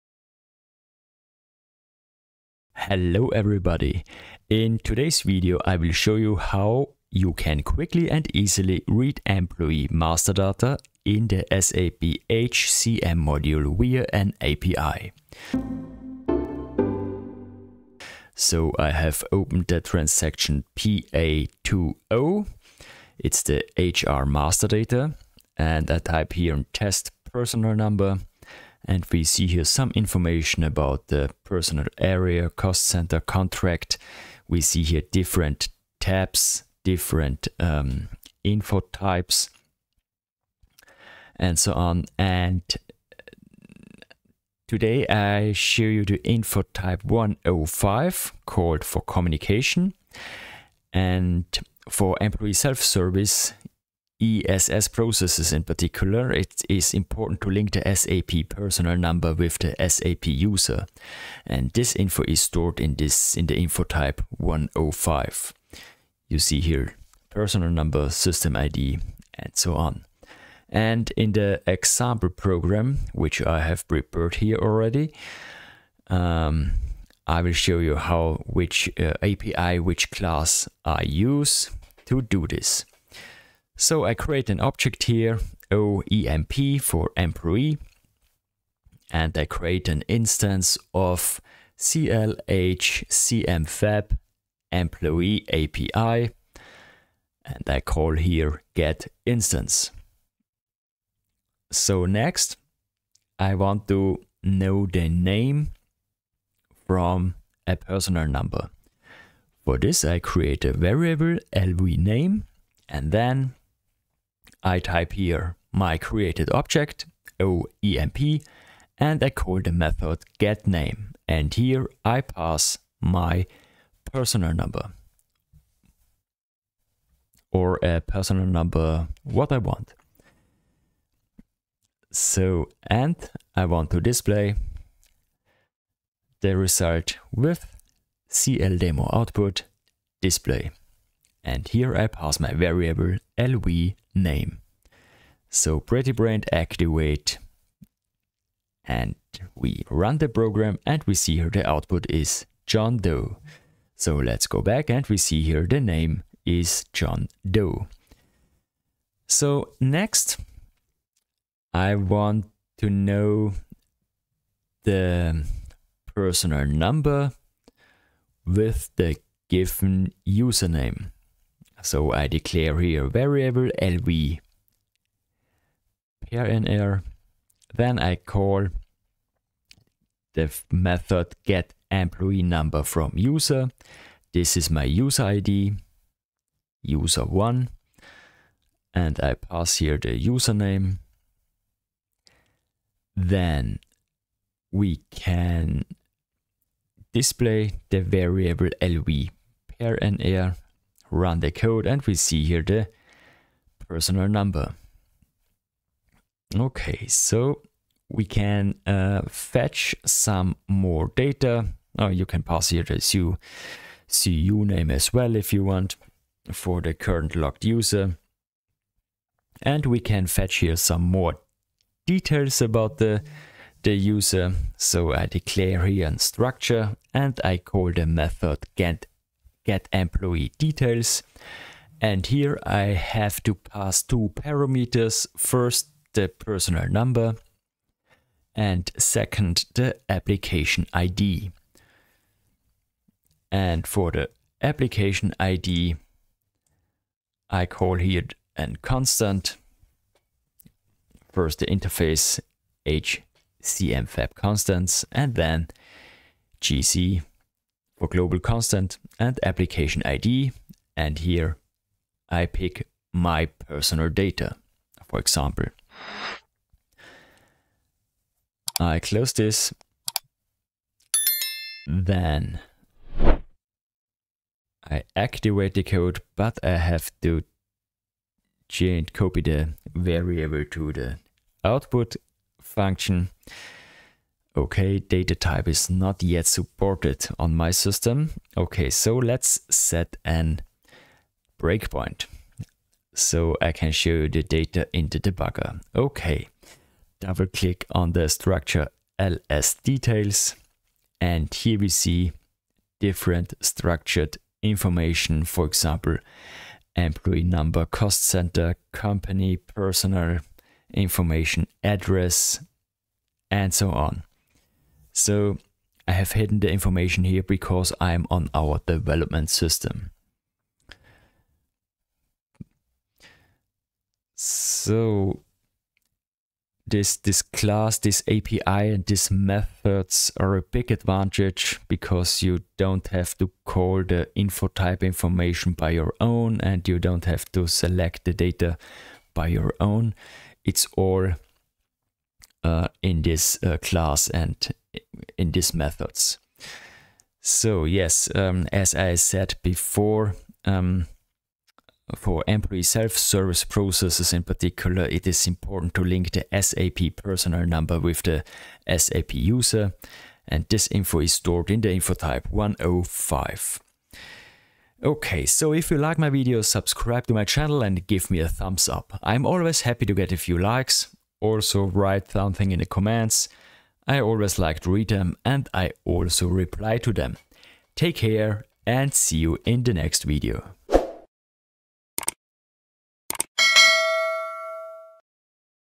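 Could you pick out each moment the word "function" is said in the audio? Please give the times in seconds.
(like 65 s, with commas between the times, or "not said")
282 s.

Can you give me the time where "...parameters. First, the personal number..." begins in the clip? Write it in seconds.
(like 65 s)
234 s.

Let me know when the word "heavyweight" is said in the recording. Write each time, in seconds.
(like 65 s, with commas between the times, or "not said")
not said.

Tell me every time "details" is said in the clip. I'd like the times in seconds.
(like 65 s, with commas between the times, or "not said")
222 s, 230 s, 299 s.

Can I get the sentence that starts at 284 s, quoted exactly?
Okay, data type is not yet supported on my system.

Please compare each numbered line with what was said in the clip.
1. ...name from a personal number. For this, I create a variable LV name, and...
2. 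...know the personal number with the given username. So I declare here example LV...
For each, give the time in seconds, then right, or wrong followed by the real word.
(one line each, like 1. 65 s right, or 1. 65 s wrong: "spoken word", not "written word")
1. 105 s right
2. 162 s wrong: "variable", not "example".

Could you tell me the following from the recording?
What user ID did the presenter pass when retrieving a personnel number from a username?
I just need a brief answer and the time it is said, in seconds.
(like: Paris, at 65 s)
user1, at 186 s.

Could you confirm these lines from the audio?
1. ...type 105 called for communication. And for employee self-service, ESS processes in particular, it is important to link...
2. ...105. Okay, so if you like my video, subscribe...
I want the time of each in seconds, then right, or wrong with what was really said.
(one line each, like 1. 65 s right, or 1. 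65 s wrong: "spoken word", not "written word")
1. 46 s right
2. 362 s right.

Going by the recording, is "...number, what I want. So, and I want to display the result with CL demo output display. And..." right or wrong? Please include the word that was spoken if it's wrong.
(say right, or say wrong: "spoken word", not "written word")
right.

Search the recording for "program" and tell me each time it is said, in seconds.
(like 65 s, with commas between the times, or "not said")
72 s, 150 s.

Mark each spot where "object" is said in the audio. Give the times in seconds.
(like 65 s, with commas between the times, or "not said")
84 s, 116 s.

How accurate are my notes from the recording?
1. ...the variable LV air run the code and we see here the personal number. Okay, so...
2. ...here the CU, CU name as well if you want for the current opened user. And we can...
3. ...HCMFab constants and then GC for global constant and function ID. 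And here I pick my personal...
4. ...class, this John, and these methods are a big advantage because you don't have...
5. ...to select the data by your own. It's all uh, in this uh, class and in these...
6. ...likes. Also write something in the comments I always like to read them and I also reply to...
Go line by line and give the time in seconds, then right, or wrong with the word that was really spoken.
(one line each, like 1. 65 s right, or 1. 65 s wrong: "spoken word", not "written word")
1. 197 s right
2. 212 s wrong: "logged", not "opened"
3. 252 s wrong: "application", not "function"
4. 327 s wrong: "API", not "John"
5. 337 s right
6. 370 s right.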